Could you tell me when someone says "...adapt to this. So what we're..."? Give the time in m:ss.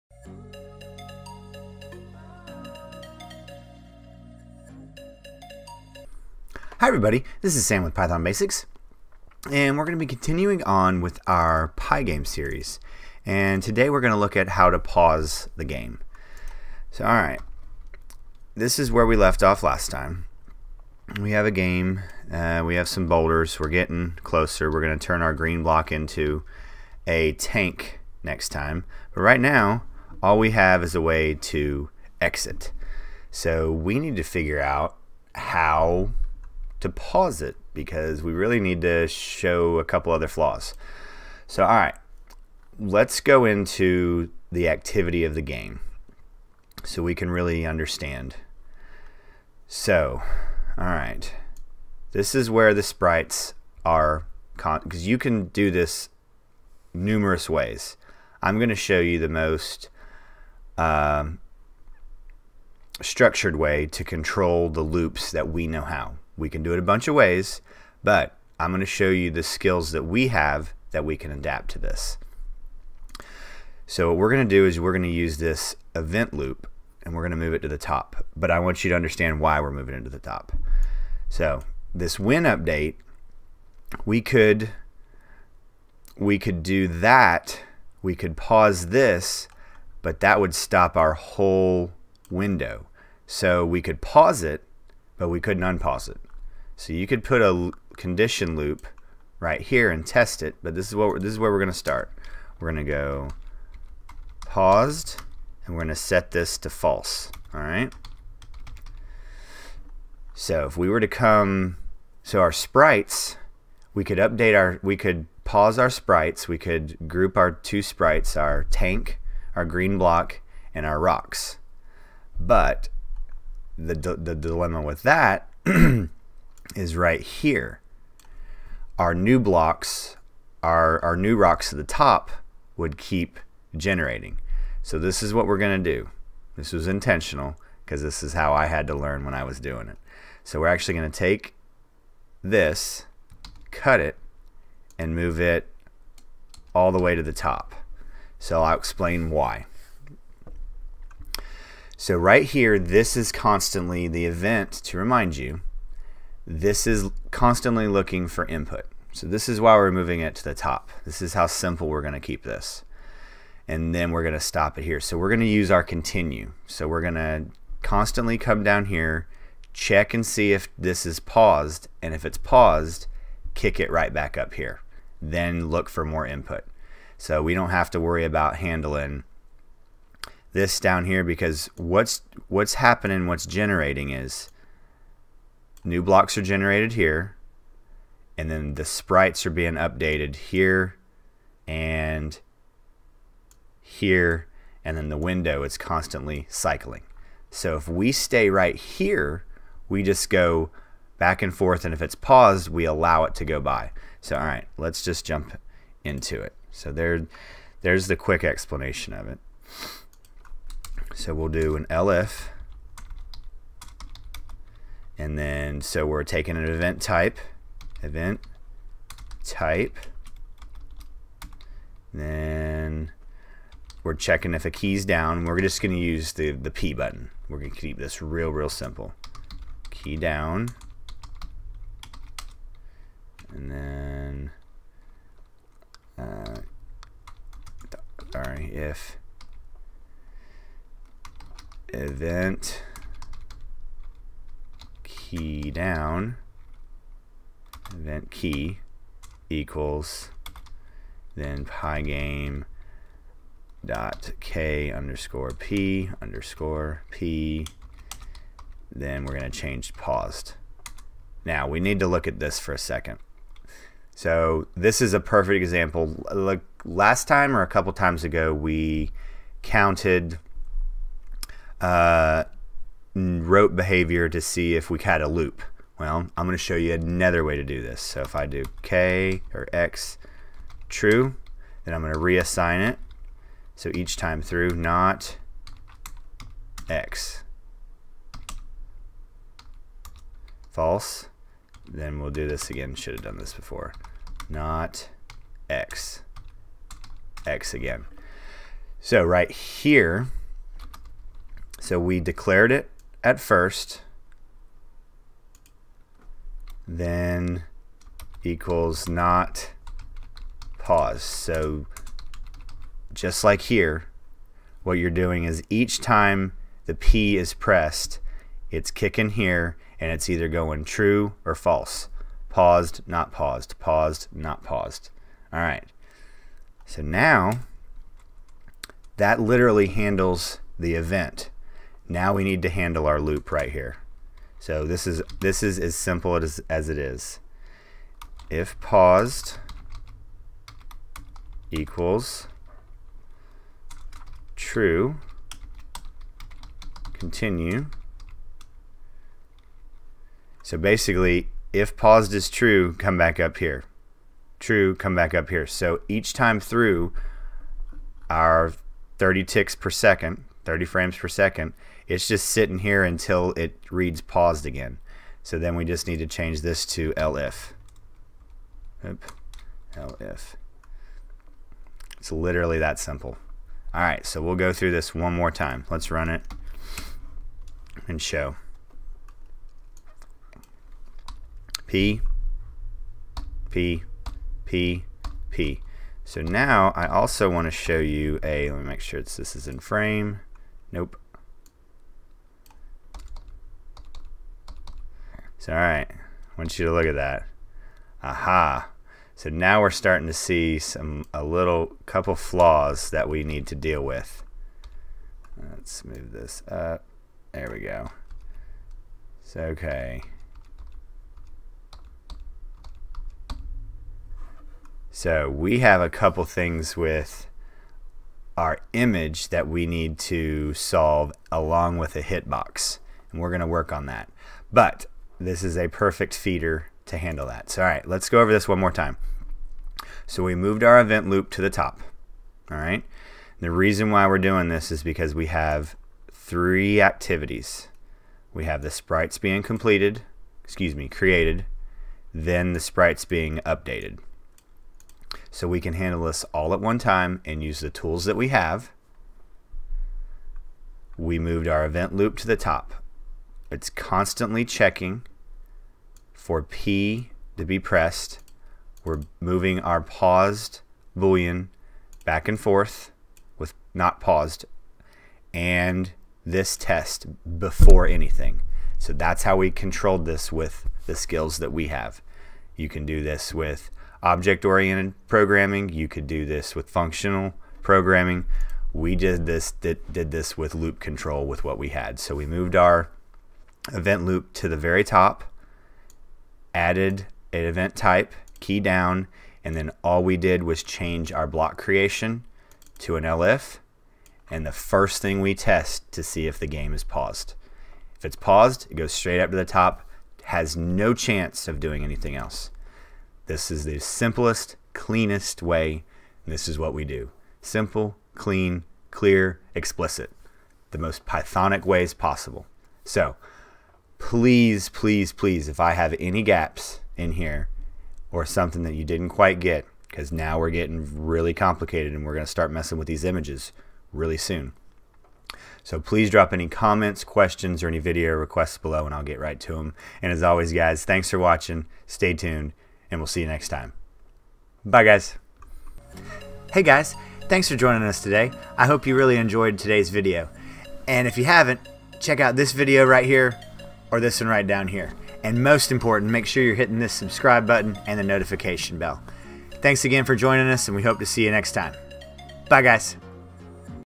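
1:11.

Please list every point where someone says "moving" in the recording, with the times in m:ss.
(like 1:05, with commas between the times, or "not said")
1:19, 2:39, 7:39.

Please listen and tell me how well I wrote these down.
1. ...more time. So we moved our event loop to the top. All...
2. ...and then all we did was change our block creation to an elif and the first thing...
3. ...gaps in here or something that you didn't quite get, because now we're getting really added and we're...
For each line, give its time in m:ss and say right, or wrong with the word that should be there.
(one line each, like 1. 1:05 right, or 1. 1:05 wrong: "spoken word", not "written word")
1. 7:08 right
2. 8:09 right
3. 8:36 wrong: "complicated", not "added".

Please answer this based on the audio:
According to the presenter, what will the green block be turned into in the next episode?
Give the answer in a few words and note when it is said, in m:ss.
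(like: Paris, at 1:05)
a tank, at 0:27.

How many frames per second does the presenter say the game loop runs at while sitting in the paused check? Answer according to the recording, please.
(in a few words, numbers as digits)
30.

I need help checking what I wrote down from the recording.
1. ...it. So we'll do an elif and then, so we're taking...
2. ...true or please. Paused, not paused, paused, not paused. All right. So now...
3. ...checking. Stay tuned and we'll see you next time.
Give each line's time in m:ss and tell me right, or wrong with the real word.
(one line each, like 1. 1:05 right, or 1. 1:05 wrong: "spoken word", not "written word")
1. 3:29 right
2. 5:20 wrong: "false", not "please"
3. 8:51 wrong: "watching", not "checking".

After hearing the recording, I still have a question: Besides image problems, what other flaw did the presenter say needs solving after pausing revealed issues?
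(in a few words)
hitbox.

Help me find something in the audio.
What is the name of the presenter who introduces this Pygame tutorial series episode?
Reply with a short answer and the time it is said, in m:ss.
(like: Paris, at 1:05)
Sam, at 0:07.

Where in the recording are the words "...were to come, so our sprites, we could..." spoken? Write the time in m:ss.
1:50.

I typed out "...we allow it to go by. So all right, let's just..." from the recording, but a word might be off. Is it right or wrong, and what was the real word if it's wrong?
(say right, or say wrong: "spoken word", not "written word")
right.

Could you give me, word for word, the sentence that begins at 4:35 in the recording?
Well, I'm going to show you another way to do this.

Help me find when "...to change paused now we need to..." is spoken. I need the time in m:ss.
4:19.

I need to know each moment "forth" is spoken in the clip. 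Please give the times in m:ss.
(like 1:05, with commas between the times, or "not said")
3:21, 7:42.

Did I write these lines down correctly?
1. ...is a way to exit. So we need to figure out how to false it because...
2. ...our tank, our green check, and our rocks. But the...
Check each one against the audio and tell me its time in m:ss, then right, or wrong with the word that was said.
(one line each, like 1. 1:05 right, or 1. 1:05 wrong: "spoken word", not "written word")
1. 0:30 wrong: "pause", not "false"
2. 1:58 wrong: "block", not "check".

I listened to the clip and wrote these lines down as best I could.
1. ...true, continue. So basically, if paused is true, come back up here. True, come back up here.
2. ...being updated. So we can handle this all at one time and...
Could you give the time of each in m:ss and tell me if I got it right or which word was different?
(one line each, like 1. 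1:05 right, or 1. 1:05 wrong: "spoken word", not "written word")
1. 5:44 right
2. 7:23 right.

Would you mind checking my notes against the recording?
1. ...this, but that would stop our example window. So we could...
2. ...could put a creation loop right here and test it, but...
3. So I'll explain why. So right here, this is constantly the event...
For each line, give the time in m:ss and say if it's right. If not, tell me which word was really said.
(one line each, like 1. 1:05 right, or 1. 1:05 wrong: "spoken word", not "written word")
1. 1:28 wrong: "whole", not "example"
2. 1:37 wrong: "condition", not "creation"
3. 2:28 right.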